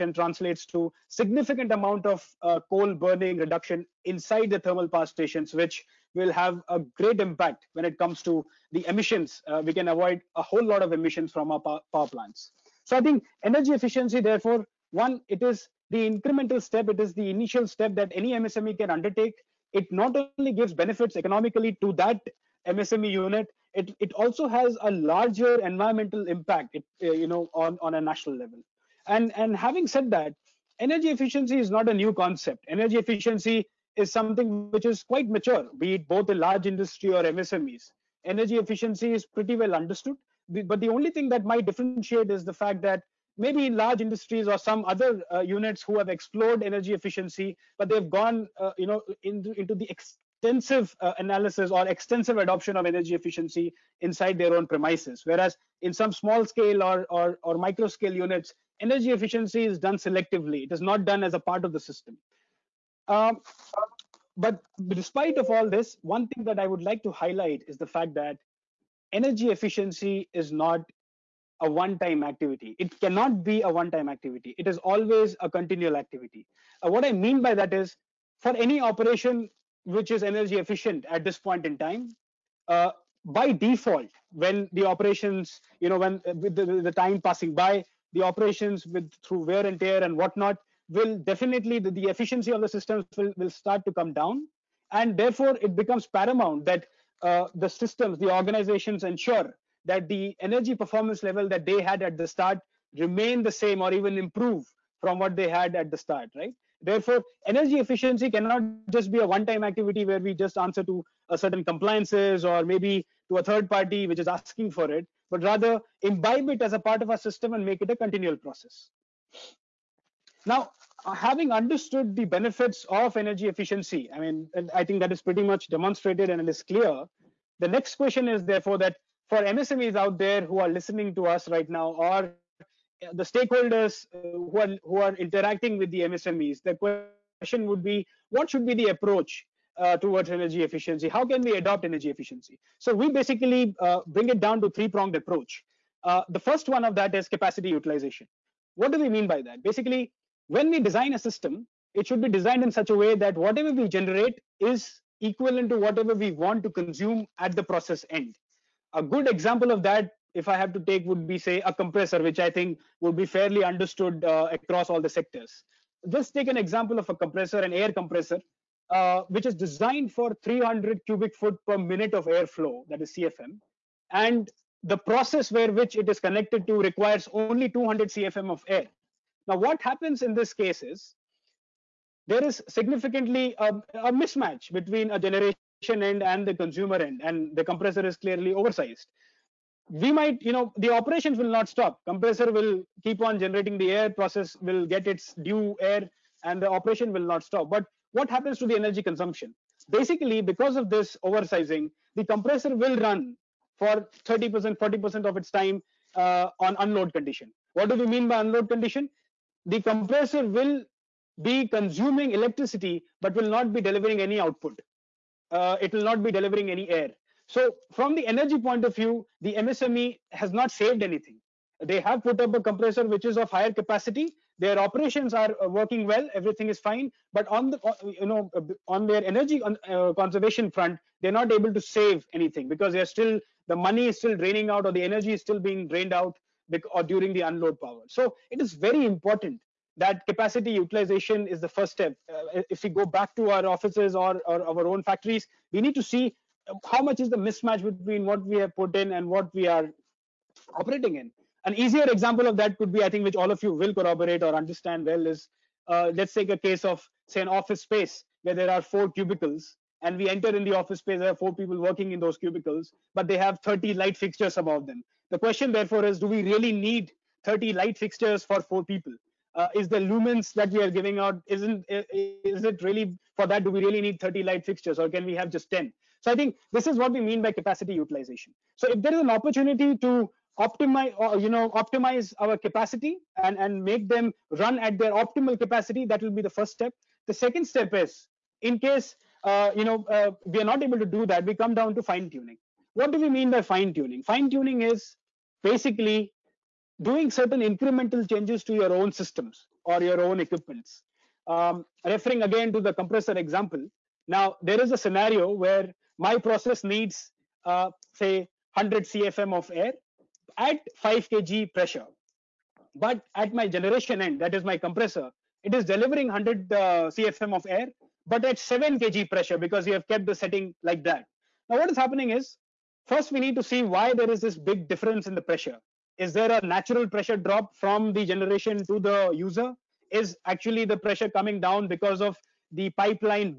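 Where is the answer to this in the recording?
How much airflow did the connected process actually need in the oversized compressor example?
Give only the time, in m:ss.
2:57.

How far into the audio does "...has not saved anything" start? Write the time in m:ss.
3:40.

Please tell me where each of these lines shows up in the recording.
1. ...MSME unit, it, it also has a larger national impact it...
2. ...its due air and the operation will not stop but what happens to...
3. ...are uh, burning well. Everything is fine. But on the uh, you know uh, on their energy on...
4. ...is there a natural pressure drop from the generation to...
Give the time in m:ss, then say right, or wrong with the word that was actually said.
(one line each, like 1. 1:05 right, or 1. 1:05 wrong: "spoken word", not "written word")
1. 0:22 wrong: "environmental", not "national"
2. 3:15 right
3. 3:45 wrong: "working", not "burning"
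4. 5:26 right.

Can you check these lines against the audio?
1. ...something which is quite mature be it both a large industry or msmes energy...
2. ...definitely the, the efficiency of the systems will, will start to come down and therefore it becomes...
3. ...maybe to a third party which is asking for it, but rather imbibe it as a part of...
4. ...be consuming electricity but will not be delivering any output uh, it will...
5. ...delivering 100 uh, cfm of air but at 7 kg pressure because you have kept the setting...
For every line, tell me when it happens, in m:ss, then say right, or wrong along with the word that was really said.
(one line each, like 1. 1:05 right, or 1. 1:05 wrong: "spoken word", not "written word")
1. 0:34 right
2. 1:31 right
3. 1:52 right
4. 3:31 right
5. 5:15 right.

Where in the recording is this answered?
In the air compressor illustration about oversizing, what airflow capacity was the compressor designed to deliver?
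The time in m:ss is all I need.
2:50.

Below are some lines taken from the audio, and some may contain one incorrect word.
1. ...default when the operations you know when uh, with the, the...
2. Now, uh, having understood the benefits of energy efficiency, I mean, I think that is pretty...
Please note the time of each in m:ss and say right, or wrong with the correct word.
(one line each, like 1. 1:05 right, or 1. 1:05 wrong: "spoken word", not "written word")
1. 1:23 right
2. 2:00 right.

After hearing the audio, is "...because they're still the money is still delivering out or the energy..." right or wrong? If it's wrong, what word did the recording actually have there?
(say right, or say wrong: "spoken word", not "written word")
wrong: "draining", not "delivering".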